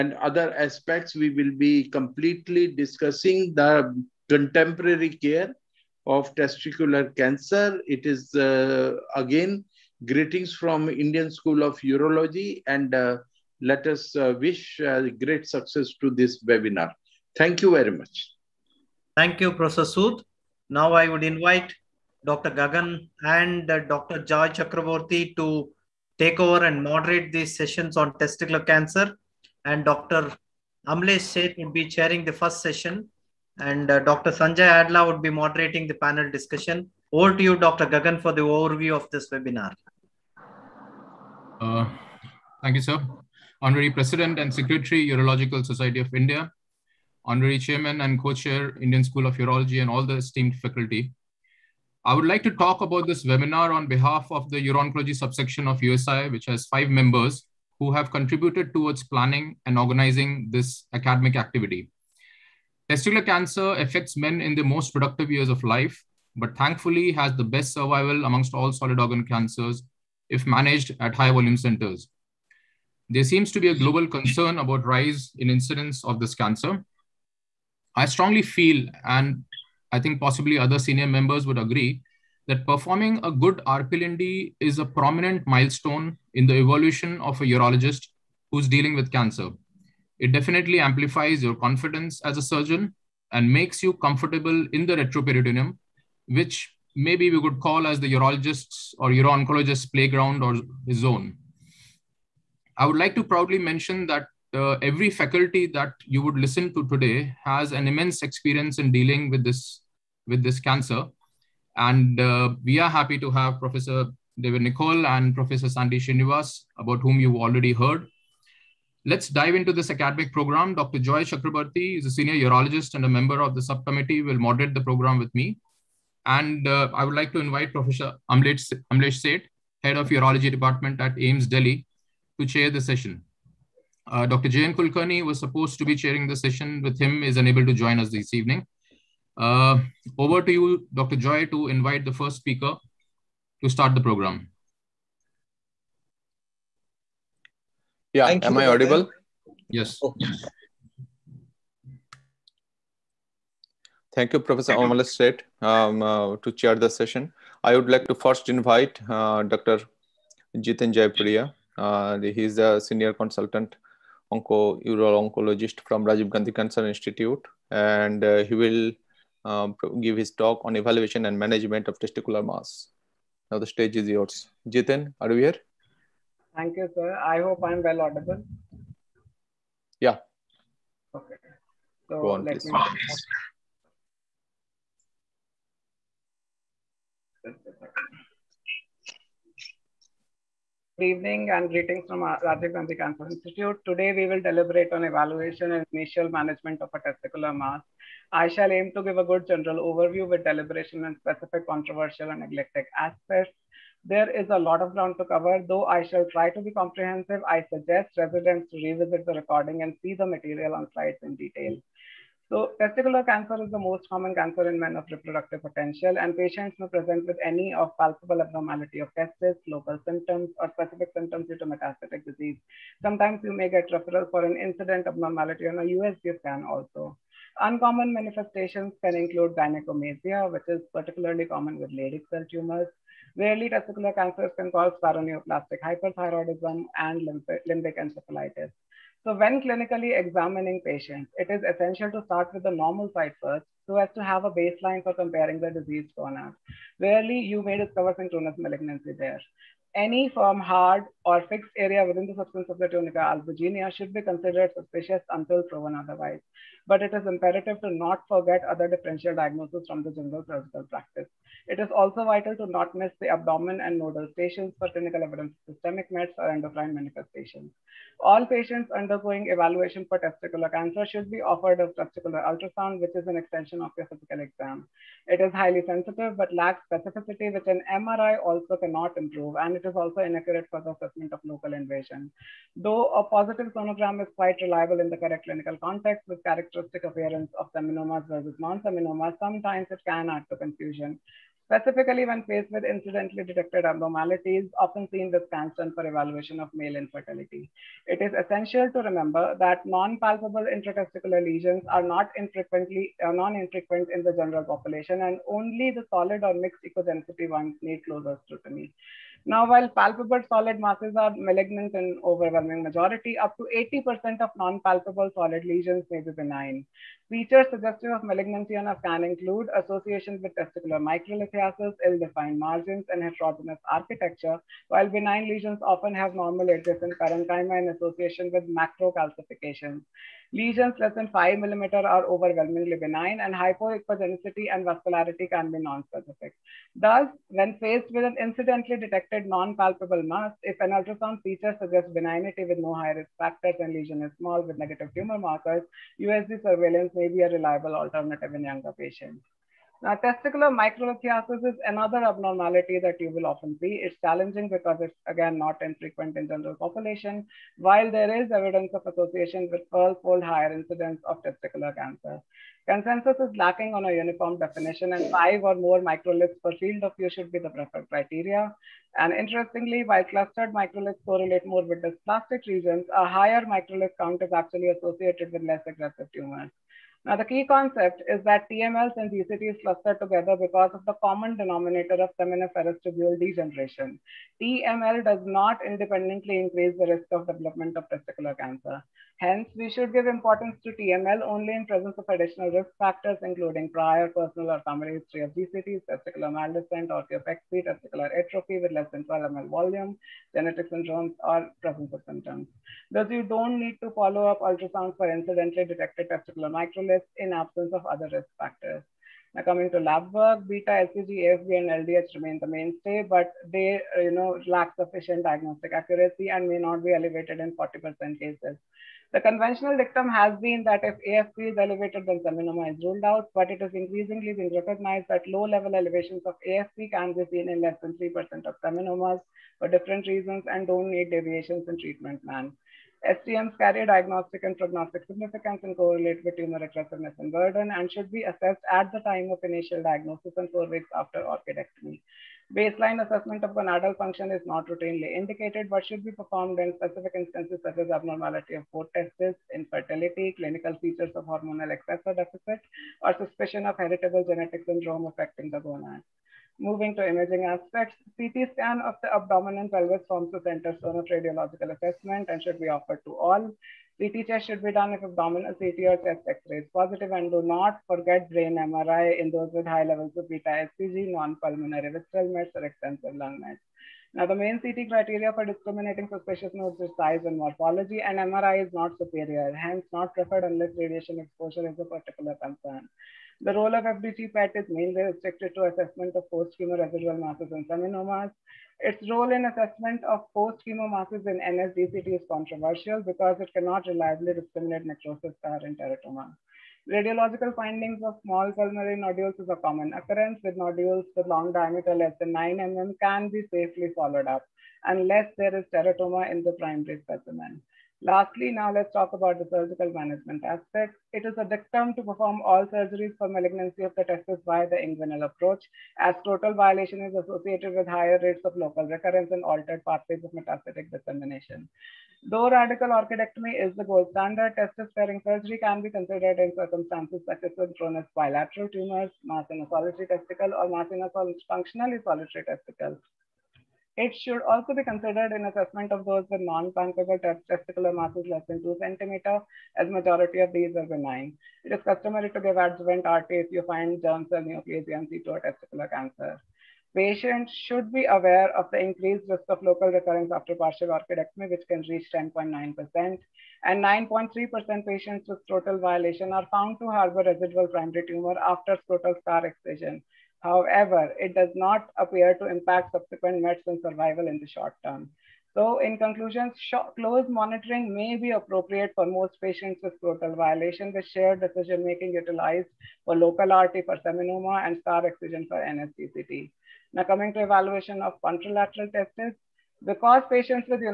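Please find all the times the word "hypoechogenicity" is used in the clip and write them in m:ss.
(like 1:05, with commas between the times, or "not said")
5:33.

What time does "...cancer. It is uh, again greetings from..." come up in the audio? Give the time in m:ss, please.
0:07.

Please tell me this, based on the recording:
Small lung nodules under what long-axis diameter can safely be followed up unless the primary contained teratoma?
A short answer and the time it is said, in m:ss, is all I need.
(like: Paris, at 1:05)
9 mm, at 8:22.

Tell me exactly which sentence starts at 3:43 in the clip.
Sometimes you may get referral for an incident abnormality on a USG scan also.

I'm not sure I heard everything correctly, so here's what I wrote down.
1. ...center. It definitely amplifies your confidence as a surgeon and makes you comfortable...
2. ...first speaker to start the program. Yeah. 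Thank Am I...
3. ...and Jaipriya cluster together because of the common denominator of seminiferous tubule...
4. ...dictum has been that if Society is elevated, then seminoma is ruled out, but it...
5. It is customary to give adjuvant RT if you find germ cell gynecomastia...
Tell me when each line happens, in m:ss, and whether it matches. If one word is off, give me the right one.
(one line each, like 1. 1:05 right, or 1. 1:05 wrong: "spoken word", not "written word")
1. 1:29 wrong: "cancer", not "center"
2. 2:22 right
3. 6:19 wrong: "GCTs", not "Jaipriya"
4. 6:59 wrong: "AFP", not "Society"
5. 9:01 wrong: "neoplasia", not "gynecomastia".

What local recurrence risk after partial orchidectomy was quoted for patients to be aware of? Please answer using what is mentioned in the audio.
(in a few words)
10.9%.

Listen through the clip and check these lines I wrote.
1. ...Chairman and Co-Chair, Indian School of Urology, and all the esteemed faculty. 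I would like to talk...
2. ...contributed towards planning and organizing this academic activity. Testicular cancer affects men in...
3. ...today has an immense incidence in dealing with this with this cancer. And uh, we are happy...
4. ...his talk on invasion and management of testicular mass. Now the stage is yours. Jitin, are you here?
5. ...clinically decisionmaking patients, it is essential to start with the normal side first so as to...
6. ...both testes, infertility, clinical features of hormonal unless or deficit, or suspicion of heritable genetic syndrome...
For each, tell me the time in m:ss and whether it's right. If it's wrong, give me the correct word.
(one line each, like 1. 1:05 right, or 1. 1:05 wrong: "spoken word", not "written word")
1. 0:47 right
2. 0:58 right
3. 1:46 wrong: "experience", not "incidence"
4. 2:50 wrong: "evaluation", not "invasion"
5. 3:59 wrong: "examining", not "decisionmaking"
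6. 7:28 wrong: "excess", not "unless".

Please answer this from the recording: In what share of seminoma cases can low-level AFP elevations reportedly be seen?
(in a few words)
less than 3%.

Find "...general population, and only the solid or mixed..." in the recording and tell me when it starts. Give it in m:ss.
5:04.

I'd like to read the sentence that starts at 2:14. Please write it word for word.
Jayan Kulkarni was supposed to be chairing the session with him, is unable to join us this evening.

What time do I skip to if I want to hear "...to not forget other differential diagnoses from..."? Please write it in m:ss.
4:17.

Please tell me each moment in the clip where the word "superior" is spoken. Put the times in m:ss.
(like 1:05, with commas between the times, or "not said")
7:59.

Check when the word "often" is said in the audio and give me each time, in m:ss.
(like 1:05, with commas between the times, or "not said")
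4:54, 5:25, 5:53.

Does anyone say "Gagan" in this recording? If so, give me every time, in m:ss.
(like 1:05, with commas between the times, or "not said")
0:22, 0:37.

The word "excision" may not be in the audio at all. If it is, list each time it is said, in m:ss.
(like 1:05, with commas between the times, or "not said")
9:19, 9:35.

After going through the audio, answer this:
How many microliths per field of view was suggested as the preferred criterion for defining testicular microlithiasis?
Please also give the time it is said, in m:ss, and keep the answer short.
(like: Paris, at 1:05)
5 or more, at 6:05.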